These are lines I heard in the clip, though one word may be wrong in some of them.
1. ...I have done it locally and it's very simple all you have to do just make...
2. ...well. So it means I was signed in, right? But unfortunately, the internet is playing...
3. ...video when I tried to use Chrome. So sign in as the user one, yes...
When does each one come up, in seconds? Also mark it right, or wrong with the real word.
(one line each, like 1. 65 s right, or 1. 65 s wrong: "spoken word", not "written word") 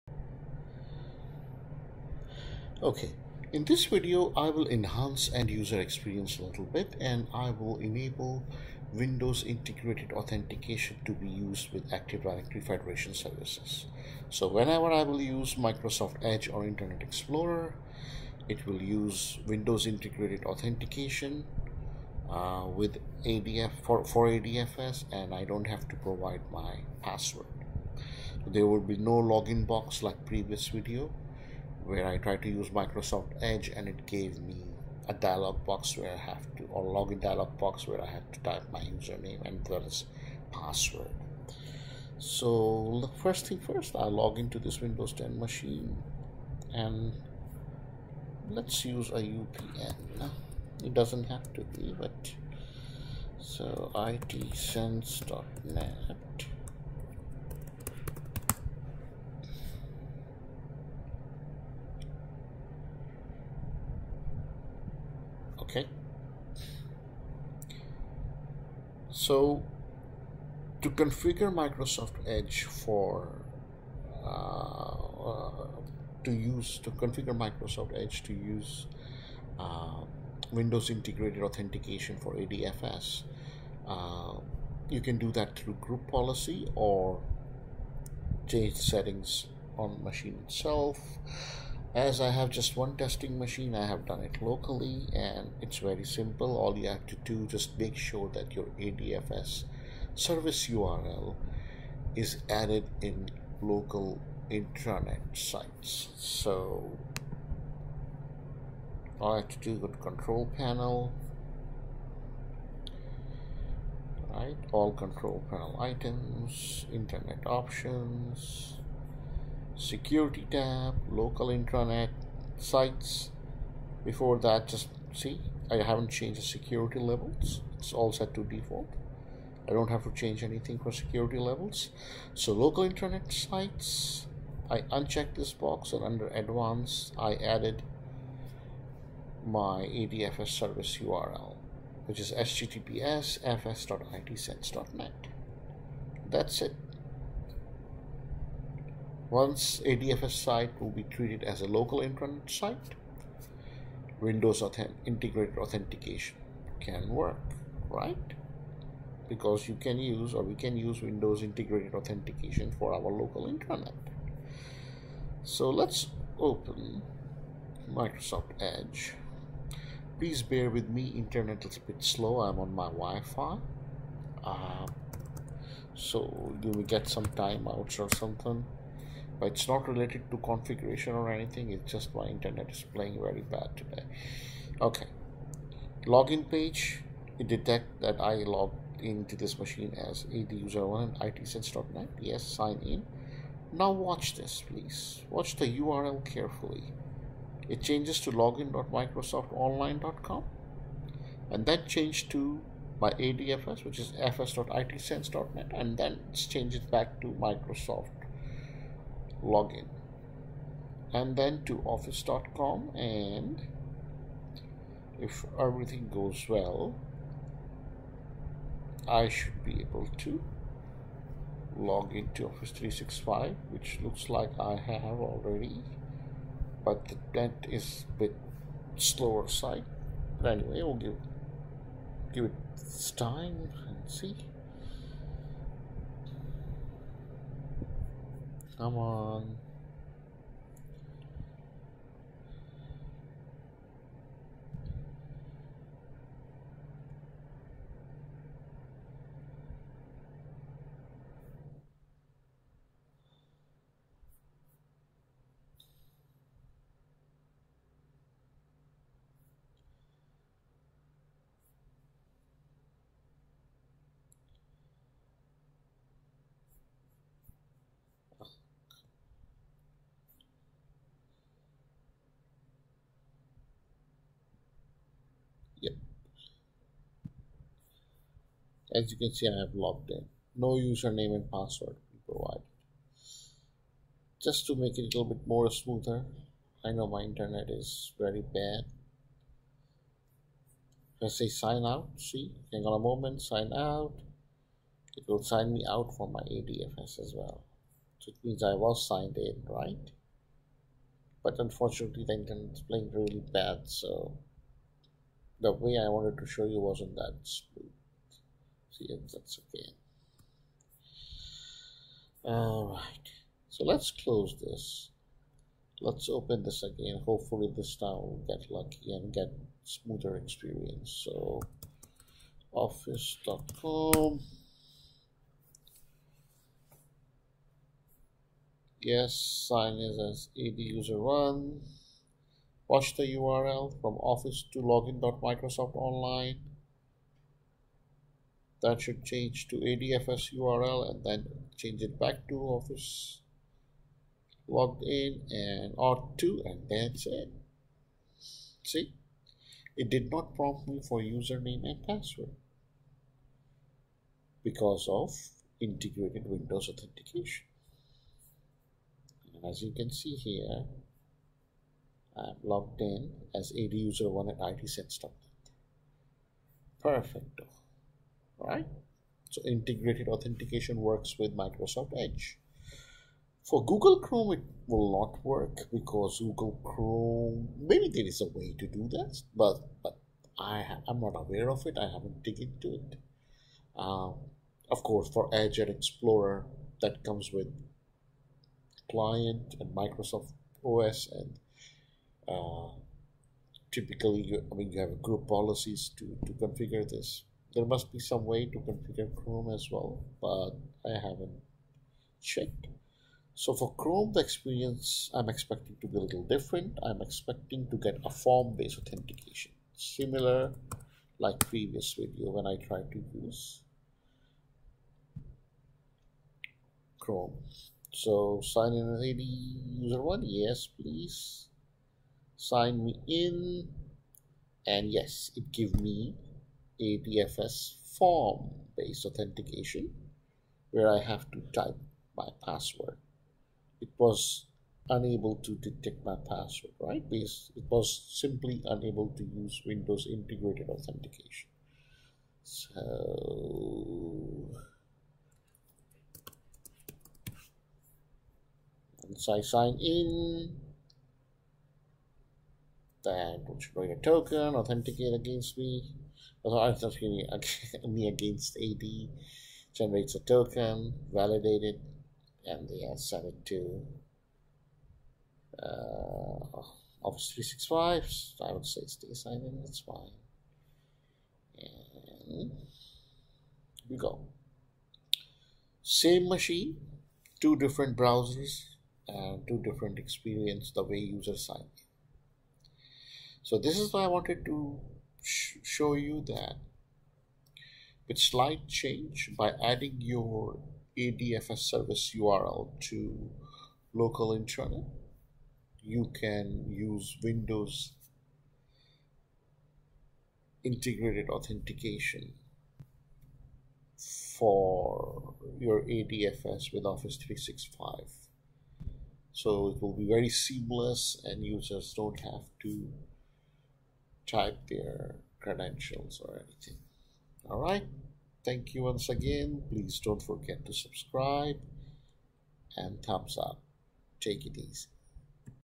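1. 93 s right
2. 297 s right
3. 412 s right.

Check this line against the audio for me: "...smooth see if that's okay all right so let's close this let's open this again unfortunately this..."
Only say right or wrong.
wrong.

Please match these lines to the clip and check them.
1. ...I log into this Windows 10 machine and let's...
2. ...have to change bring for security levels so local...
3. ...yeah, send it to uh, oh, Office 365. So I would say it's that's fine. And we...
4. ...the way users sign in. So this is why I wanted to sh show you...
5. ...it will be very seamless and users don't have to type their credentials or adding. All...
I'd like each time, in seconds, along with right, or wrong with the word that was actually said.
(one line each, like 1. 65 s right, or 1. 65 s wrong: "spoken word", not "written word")
1. 43 s right
2. 129 s wrong: "anything", not "bring"
3. 463 s right
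4. 480 s right
5. 509 s wrong: "anything", not "adding".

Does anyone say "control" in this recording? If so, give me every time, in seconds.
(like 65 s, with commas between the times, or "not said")
109 s, 114 s.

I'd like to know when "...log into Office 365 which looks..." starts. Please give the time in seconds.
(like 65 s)
221 s.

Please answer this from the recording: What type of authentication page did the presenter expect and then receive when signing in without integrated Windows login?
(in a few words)
Form-based authentication.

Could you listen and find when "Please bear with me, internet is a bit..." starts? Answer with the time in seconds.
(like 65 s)
170 s.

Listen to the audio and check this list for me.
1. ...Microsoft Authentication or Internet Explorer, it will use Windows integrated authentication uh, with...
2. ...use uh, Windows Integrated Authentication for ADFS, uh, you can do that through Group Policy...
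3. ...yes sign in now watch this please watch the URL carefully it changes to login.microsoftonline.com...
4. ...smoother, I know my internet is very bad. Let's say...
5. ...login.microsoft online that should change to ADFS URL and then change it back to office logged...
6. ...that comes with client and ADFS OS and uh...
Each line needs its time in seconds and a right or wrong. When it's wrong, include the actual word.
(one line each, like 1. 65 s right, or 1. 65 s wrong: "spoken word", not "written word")
1. 15 s wrong: "Edge", not "Authentication"
2. 78 s right
3. 192 s right
4. 285 s right
5. 334 s right
6. 387 s wrong: "Microsoft", not "ADFS".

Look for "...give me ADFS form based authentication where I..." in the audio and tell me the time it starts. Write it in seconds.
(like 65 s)
425 s.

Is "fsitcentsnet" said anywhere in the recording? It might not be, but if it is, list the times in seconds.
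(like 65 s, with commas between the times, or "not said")
143 s, 204 s.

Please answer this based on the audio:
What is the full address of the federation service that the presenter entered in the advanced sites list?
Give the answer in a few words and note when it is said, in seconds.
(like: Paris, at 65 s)
https fs.itcents.net, at 142 s.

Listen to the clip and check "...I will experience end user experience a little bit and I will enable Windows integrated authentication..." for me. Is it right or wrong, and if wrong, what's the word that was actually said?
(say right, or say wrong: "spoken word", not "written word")
wrong: "enhance", not "experience".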